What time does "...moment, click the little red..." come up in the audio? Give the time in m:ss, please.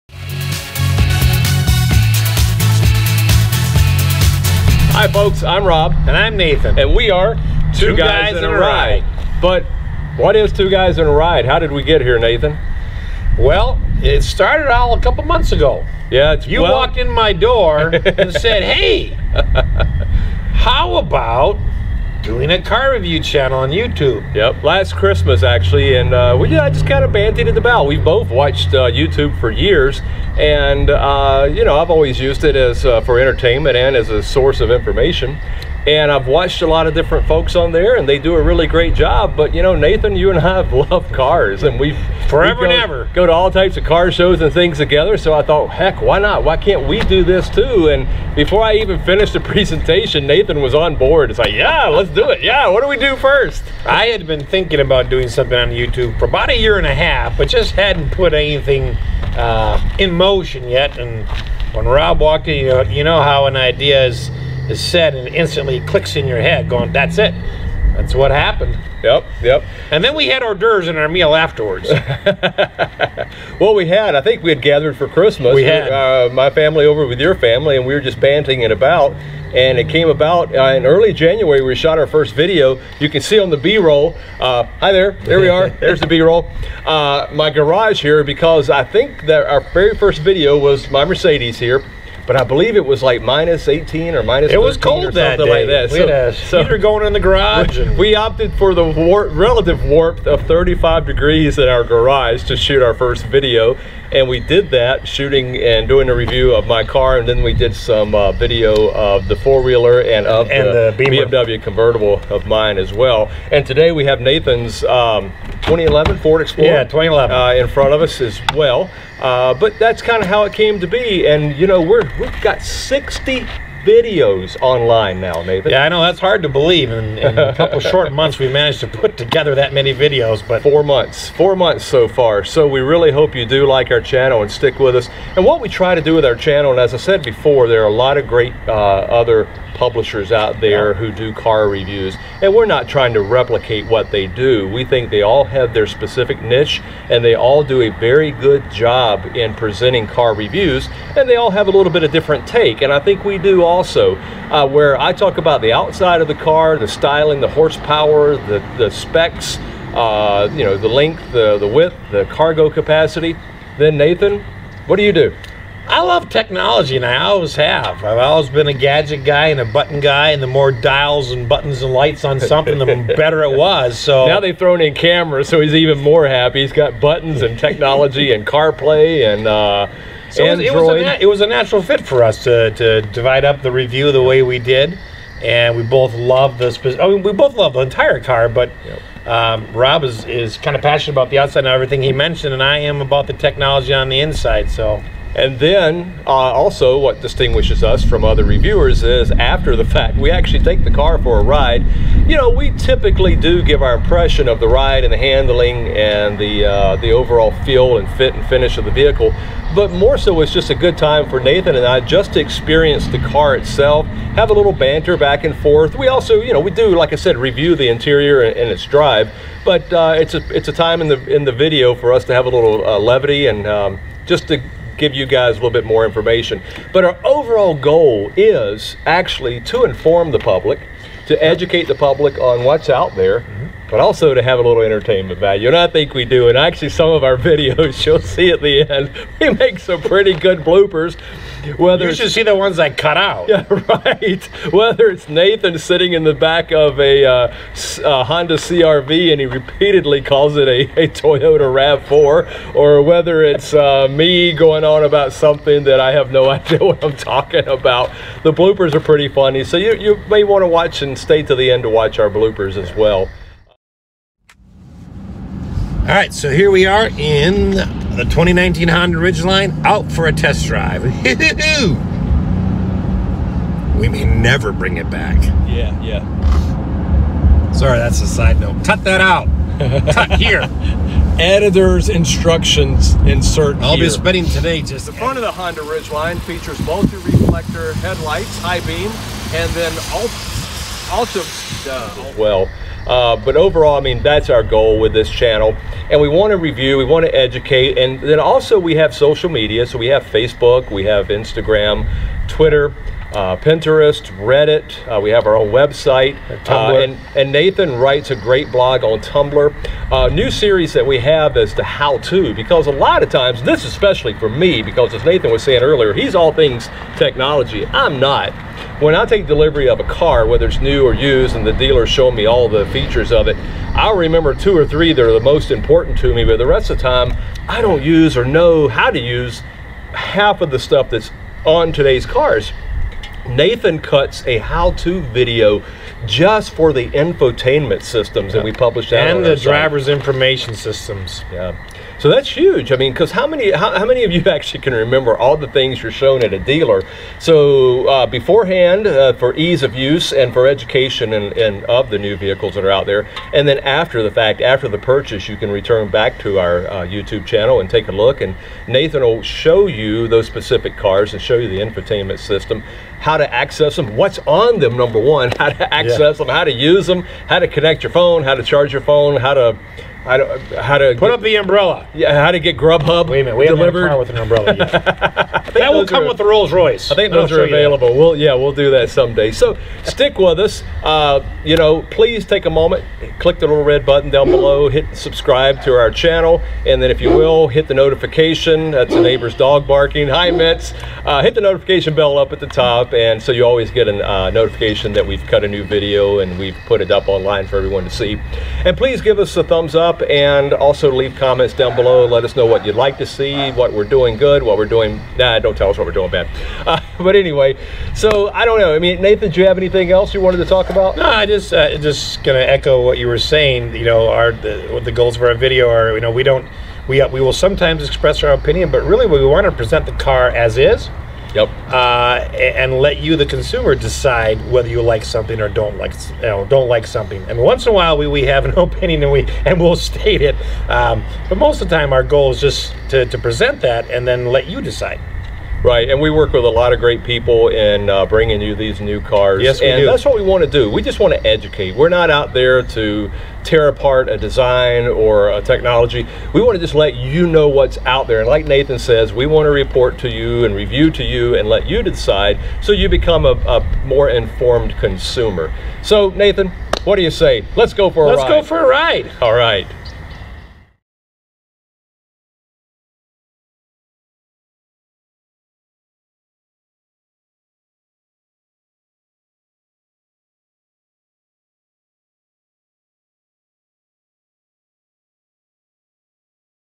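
6:22.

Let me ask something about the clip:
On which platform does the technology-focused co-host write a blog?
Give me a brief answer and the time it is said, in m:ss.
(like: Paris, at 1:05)
Tumblr, at 5:09.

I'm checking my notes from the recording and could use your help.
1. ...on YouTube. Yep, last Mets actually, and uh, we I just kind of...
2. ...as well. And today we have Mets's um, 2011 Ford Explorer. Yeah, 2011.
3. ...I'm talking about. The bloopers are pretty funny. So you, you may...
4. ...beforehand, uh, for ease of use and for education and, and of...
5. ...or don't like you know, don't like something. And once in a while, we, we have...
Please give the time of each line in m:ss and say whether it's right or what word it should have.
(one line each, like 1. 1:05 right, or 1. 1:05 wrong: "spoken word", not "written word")
1. 0:23 wrong: "Christmas", not "Mets"
2. 1:52 wrong: "Nathan", not "Mets"
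3. 4:17 right
4. 5:48 right
5. 7:05 right.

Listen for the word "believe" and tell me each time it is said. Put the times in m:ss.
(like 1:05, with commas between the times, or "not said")
1:32, 2:06.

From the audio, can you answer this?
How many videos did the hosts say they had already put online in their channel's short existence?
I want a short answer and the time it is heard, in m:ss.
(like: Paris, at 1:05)
60, at 2:02.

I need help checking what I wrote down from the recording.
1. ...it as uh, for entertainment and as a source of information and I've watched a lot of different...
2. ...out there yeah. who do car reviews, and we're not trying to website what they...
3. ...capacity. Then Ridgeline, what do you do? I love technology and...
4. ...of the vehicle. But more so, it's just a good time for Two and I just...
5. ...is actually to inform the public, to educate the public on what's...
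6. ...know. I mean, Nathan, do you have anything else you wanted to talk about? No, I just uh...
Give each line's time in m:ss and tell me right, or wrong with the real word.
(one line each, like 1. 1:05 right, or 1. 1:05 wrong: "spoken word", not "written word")
1. 0:32 right
2. 2:20 wrong: "replicate", not "website"
3. 2:42 wrong: "Nathan", not "Ridgeline"
4. 3:28 wrong: "Nathan", not "Two"
5. 3:48 right
6. 6:48 right.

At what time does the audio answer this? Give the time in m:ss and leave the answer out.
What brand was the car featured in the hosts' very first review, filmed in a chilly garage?
1:31.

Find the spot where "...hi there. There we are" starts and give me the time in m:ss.
1:24.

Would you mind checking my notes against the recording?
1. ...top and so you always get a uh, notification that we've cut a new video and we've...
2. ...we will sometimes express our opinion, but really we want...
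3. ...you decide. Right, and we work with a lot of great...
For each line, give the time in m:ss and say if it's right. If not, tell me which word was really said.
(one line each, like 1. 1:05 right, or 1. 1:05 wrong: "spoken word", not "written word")
1. 6:32 right
2. 6:57 right
3. 7:14 right.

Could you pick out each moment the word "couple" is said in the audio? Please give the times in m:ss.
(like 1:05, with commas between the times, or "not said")
0:15, 2:07.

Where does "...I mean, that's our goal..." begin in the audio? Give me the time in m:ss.
4:53.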